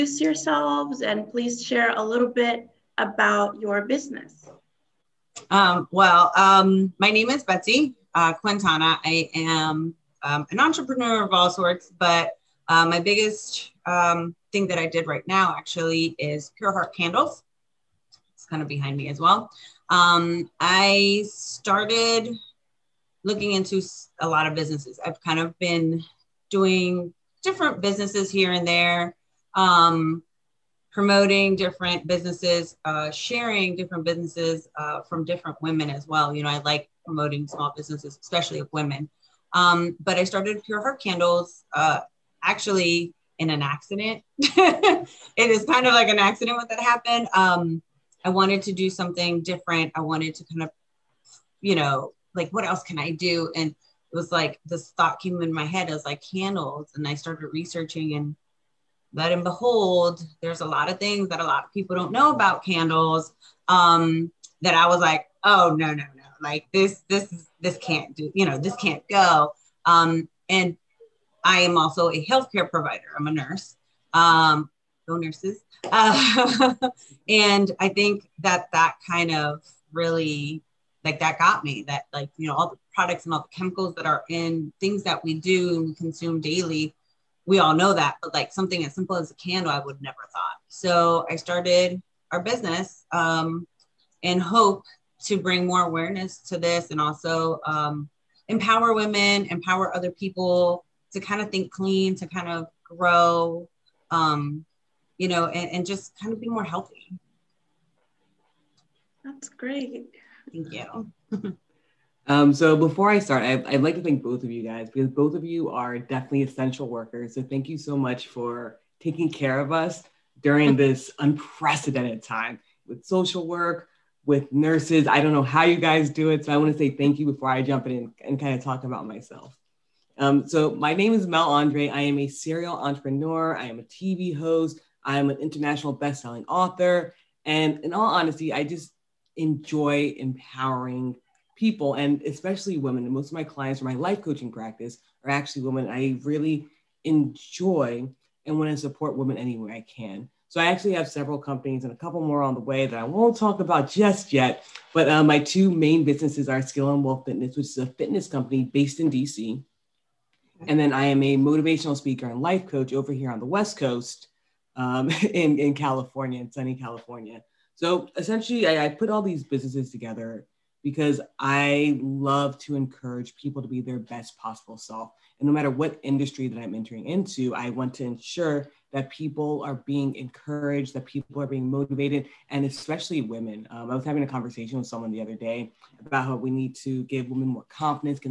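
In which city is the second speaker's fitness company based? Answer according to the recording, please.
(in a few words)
DC.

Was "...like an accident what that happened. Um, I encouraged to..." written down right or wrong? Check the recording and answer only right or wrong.
wrong.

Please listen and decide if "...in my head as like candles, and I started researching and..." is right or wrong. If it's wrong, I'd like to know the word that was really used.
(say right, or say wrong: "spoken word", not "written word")
right.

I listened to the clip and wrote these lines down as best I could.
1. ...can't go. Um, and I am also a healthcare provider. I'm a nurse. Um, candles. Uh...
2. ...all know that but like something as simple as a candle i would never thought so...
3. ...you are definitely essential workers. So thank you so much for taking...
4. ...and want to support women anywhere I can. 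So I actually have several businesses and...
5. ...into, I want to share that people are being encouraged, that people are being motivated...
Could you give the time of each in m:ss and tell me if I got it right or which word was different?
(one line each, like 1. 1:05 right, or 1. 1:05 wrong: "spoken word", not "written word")
1. 1:08 wrong: "nurses", not "candles"
2. 1:27 right
3. 1:55 right
4. 2:28 wrong: "companies", not "businesses"
5. 2:57 wrong: "ensure", not "share".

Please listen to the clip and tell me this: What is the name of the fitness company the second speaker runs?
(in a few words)
Skill and Wealth Fitness.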